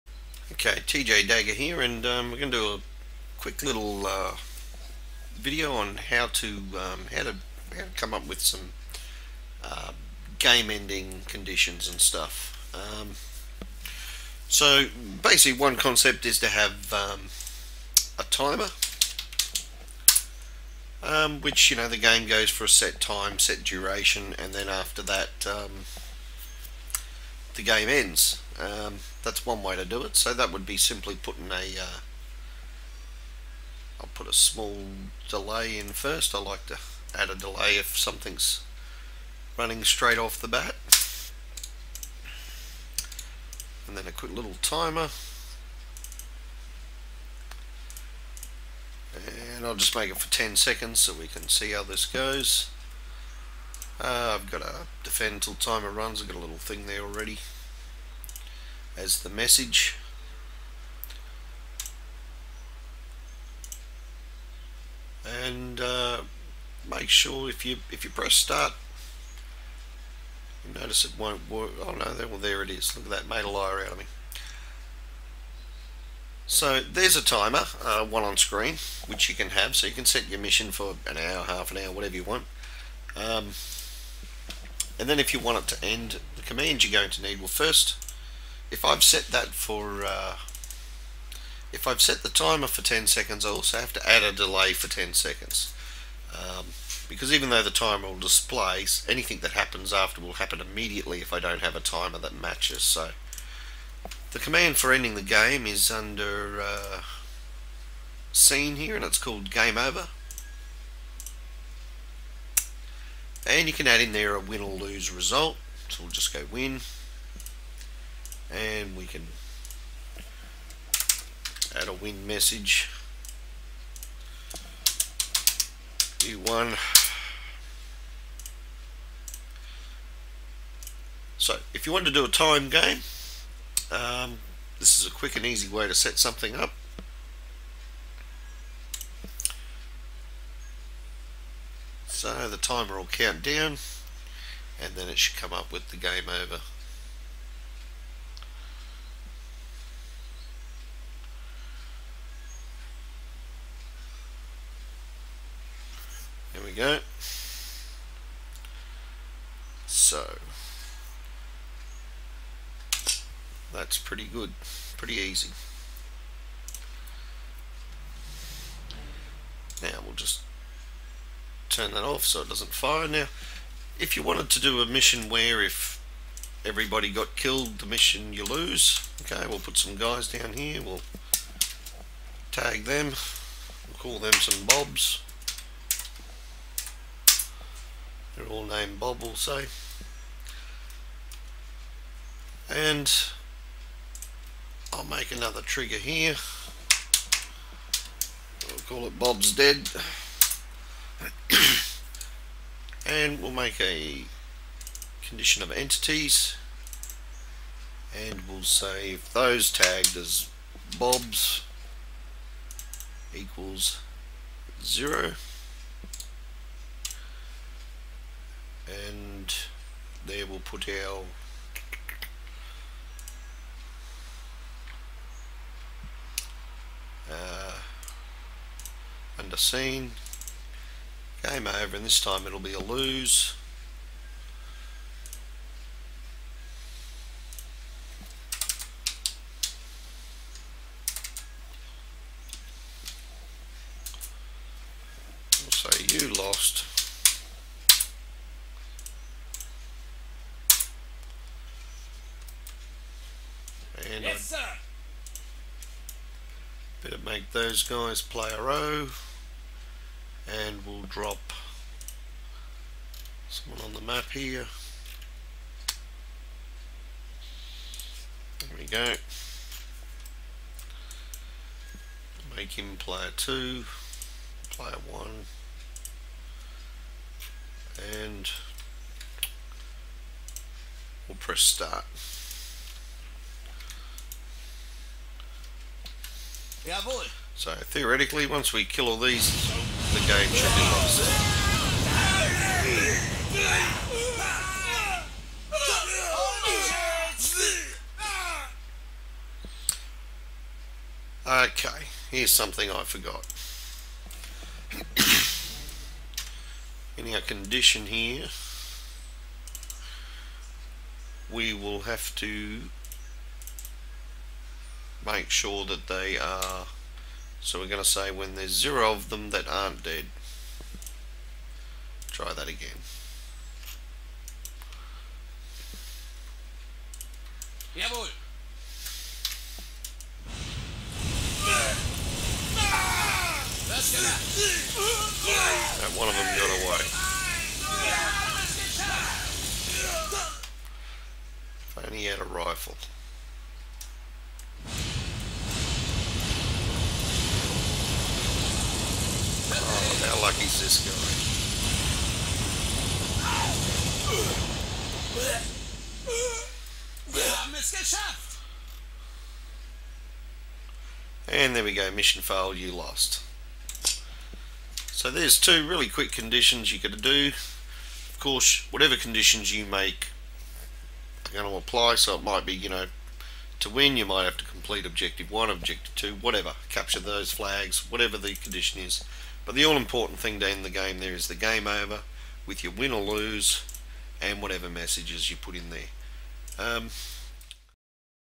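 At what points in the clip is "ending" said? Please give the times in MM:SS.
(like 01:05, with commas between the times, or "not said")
00:10, 01:44.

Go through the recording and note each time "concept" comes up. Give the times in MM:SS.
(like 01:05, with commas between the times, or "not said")
00:15.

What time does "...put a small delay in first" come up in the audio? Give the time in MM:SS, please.
00:34.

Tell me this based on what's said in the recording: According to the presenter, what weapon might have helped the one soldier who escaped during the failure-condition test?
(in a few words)
a rifle.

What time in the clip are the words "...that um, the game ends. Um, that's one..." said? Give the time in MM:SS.
00:25.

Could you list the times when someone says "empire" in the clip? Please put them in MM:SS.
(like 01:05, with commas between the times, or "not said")
not said.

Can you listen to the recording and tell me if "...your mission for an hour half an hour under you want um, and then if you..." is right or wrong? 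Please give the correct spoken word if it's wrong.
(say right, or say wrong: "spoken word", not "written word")
wrong: "whatever", not "under".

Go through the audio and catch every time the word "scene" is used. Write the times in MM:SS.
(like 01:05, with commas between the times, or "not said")
01:48, 03:49.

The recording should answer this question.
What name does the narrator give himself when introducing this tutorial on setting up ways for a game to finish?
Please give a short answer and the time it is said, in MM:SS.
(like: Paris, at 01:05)
TJ Dagger, at 00:00.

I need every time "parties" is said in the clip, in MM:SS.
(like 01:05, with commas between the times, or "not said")
not said.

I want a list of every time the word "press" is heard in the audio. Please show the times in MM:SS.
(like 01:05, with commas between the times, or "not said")
01:08, 04:41.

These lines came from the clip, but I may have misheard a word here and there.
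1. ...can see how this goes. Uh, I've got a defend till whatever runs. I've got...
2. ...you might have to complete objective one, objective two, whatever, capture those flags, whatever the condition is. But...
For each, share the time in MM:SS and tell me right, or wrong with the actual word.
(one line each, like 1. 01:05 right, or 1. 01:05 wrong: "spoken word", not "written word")
1. 00:51 wrong: "timer", not "whatever"
2. 06:14 right.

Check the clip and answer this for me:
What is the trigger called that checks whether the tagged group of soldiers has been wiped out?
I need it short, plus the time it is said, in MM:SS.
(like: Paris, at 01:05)
Bob's Dead, at 03:19.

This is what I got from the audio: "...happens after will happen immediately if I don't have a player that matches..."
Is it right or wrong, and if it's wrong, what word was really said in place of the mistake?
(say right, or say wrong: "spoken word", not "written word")
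wrong: "timer", not "player".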